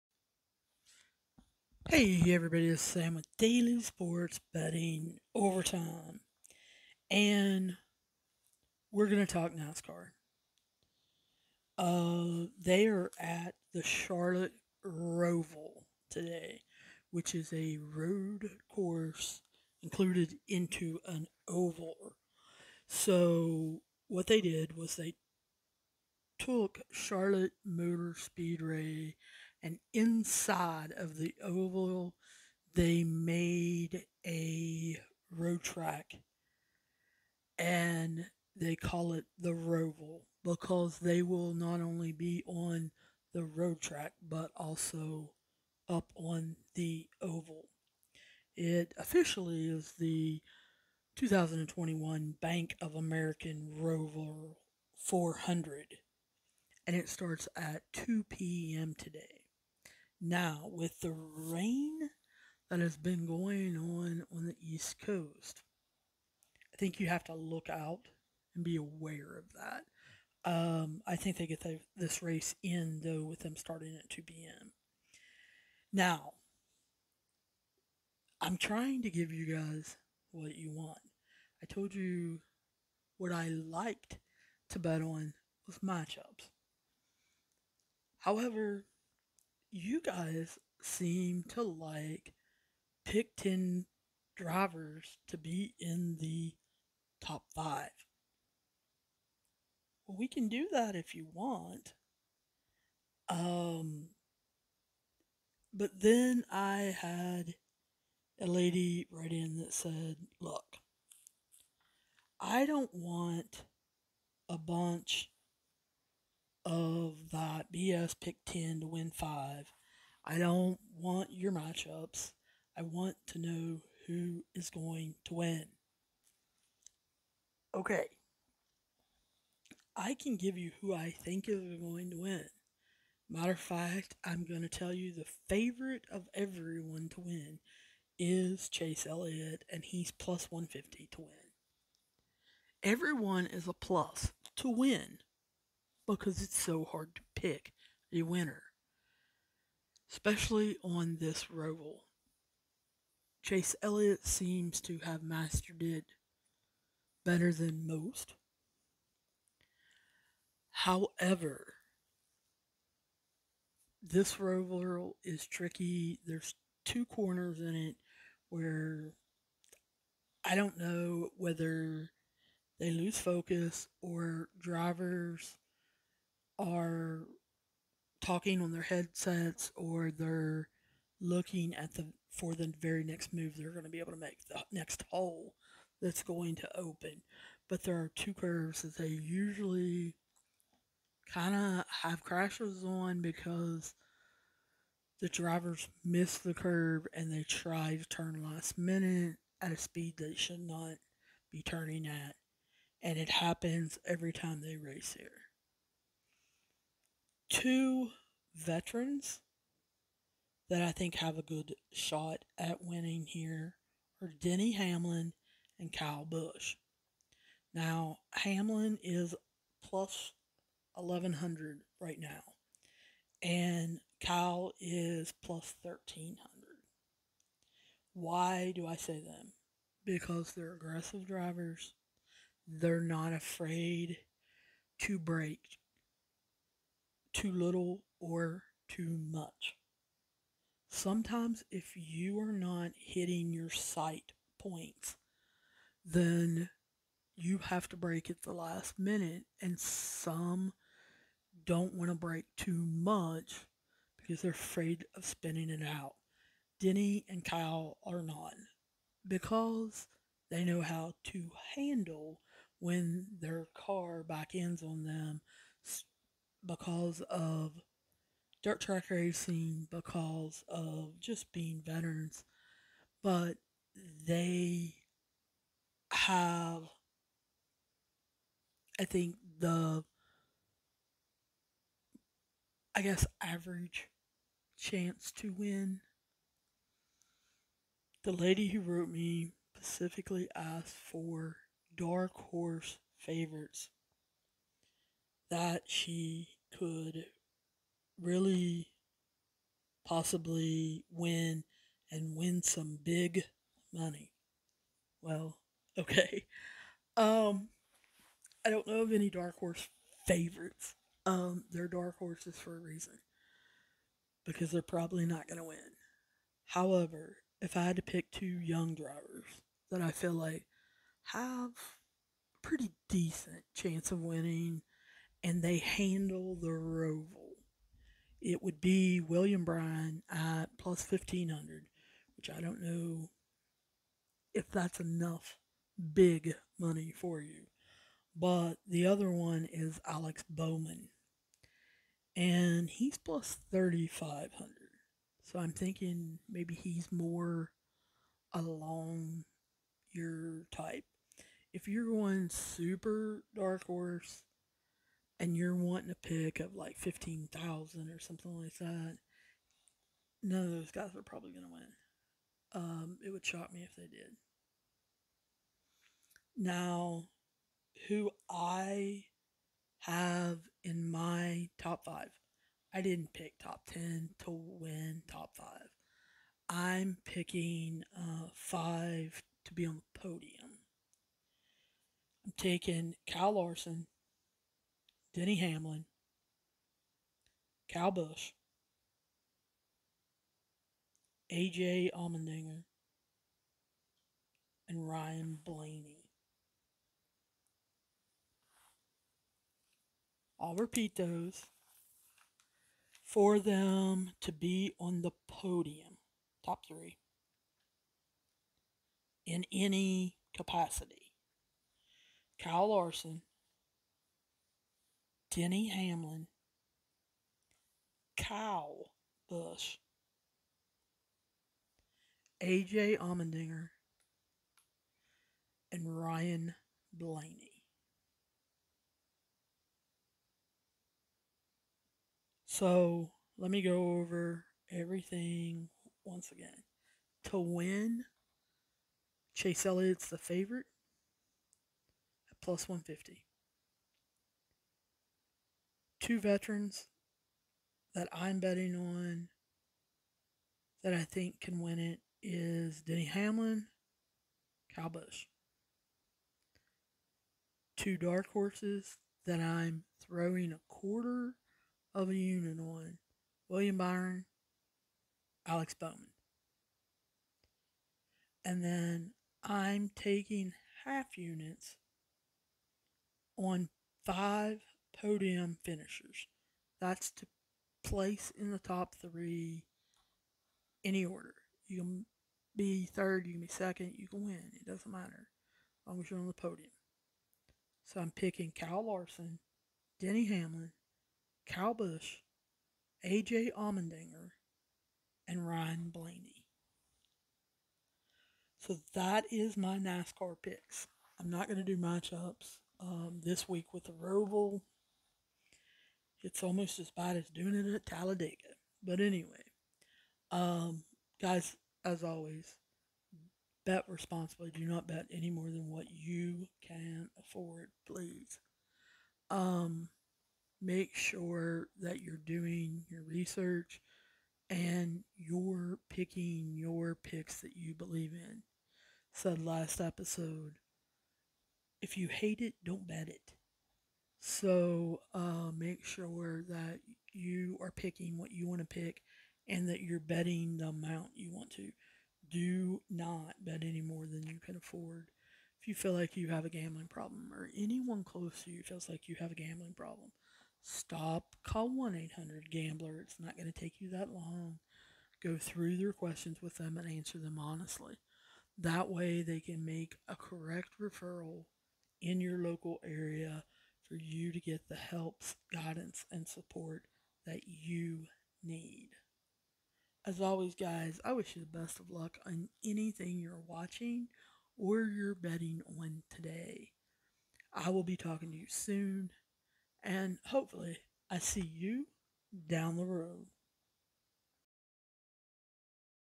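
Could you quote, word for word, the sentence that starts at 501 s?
I'm not going to do matchups um, this week with the Roval it's almost as bad as doing it at Talladega.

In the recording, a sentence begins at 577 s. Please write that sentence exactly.
I will be talking to you soon, and hopefully, I see you down the road.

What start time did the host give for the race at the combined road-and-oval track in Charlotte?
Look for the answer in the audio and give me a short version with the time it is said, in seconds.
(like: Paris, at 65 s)
2 p.m., at 56 s.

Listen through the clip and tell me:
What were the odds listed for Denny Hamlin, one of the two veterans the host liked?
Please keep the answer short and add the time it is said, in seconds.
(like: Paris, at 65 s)
+1100, at 219 s.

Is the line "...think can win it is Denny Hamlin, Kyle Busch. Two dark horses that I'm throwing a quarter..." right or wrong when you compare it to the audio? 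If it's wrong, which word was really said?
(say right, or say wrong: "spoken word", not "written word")
right.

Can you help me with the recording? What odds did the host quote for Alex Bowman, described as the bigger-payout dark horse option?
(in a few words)
+3500.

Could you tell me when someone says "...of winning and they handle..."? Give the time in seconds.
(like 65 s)
324 s.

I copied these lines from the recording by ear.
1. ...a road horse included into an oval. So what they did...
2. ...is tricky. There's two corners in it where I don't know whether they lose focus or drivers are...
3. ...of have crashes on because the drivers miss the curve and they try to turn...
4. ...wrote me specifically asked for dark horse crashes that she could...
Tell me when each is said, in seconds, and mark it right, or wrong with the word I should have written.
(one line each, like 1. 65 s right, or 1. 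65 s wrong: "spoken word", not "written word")
1. 17 s wrong: "course", not "horse"
2. 165 s right
3. 191 s right
4. 288 s wrong: "favorites", not "crashes".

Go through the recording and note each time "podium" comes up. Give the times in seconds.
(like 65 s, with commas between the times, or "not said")
380 s, 405 s, 475 s, 486 s.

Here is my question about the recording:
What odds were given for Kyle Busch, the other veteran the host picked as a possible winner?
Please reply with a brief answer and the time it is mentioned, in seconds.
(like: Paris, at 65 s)
+1300, at 224 s.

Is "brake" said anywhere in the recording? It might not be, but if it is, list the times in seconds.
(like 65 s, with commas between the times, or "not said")
235 s, 247 s, 252 s.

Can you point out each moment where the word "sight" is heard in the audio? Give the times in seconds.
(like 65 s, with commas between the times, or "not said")
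243 s.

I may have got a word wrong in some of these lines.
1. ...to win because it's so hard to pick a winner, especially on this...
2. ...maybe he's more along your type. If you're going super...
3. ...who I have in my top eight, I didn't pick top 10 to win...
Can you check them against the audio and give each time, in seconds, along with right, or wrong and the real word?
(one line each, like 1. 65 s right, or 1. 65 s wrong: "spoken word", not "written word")
1. 144 s right
2. 346 s right
3. 368 s wrong: "five", not "eight".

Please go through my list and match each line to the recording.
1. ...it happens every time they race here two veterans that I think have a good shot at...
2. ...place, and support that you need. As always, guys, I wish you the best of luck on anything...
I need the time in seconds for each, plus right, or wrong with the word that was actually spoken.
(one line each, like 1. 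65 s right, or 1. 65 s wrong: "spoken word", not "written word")
1. 203 s right
2. 565 s wrong: "guidance", not "place".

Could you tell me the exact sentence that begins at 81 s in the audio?
I told you what I liked to bet on was matchups.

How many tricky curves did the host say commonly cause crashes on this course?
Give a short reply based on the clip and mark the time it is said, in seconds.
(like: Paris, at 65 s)
2, at 188 s.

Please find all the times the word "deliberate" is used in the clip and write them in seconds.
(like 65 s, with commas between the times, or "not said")
not said.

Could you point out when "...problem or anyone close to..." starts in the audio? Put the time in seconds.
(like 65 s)
547 s.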